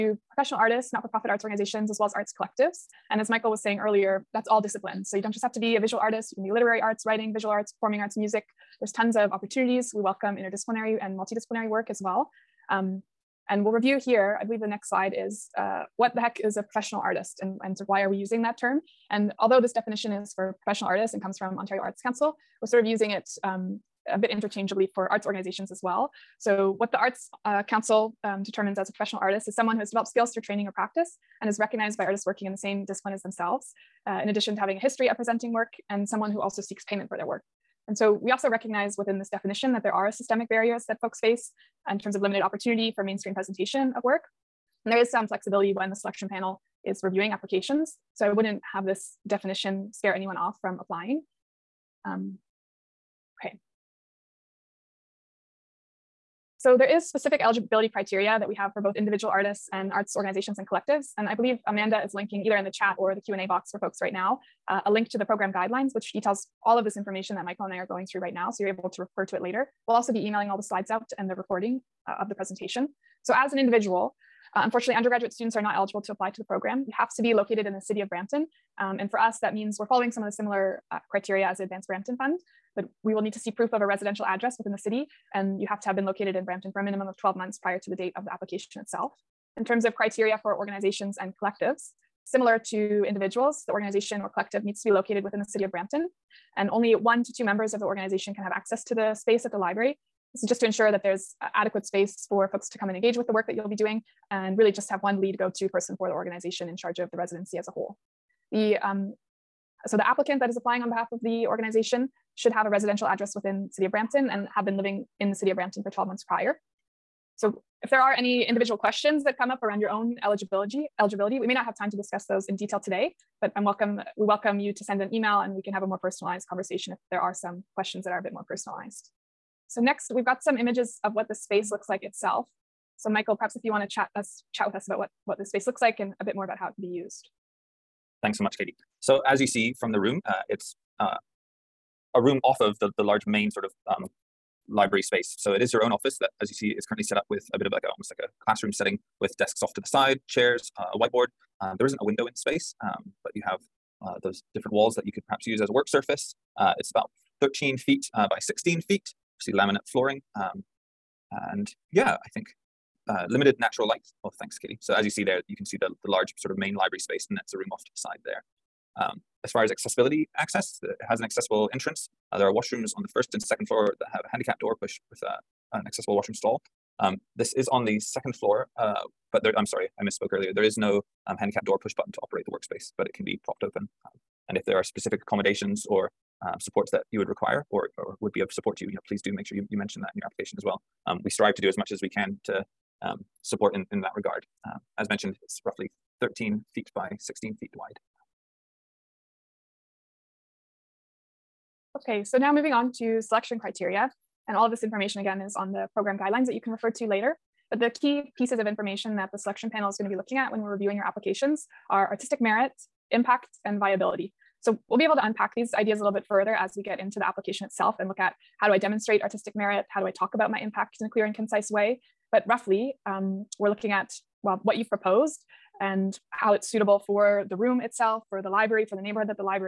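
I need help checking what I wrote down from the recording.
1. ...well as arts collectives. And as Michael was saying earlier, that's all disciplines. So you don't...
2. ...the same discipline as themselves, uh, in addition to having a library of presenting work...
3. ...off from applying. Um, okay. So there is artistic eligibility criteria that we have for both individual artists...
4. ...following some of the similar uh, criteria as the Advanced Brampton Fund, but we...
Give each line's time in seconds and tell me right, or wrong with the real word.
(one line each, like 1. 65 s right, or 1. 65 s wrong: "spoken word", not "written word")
1. 1 s right
2. 32 s wrong: "history", not "library"
3. 50 s wrong: "specific", not "artistic"
4. 79 s right.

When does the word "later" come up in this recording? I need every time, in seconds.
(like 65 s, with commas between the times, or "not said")
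69 s, 207 s.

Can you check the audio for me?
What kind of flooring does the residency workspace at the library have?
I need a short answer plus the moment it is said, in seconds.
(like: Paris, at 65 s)
Laminate, at 159 s.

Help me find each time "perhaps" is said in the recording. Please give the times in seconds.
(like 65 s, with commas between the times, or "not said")
133 s, 155 s.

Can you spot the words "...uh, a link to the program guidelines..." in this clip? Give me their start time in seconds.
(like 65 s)
64 s.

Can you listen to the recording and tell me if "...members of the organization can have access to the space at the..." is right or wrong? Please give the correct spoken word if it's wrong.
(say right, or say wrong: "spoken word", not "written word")
right.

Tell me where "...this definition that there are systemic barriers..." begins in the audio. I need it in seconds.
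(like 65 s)
39 s.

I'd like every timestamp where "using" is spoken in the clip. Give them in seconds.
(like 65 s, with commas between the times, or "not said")
18 s, 22 s.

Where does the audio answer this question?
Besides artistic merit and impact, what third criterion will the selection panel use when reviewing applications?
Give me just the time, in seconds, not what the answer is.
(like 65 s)
213 s.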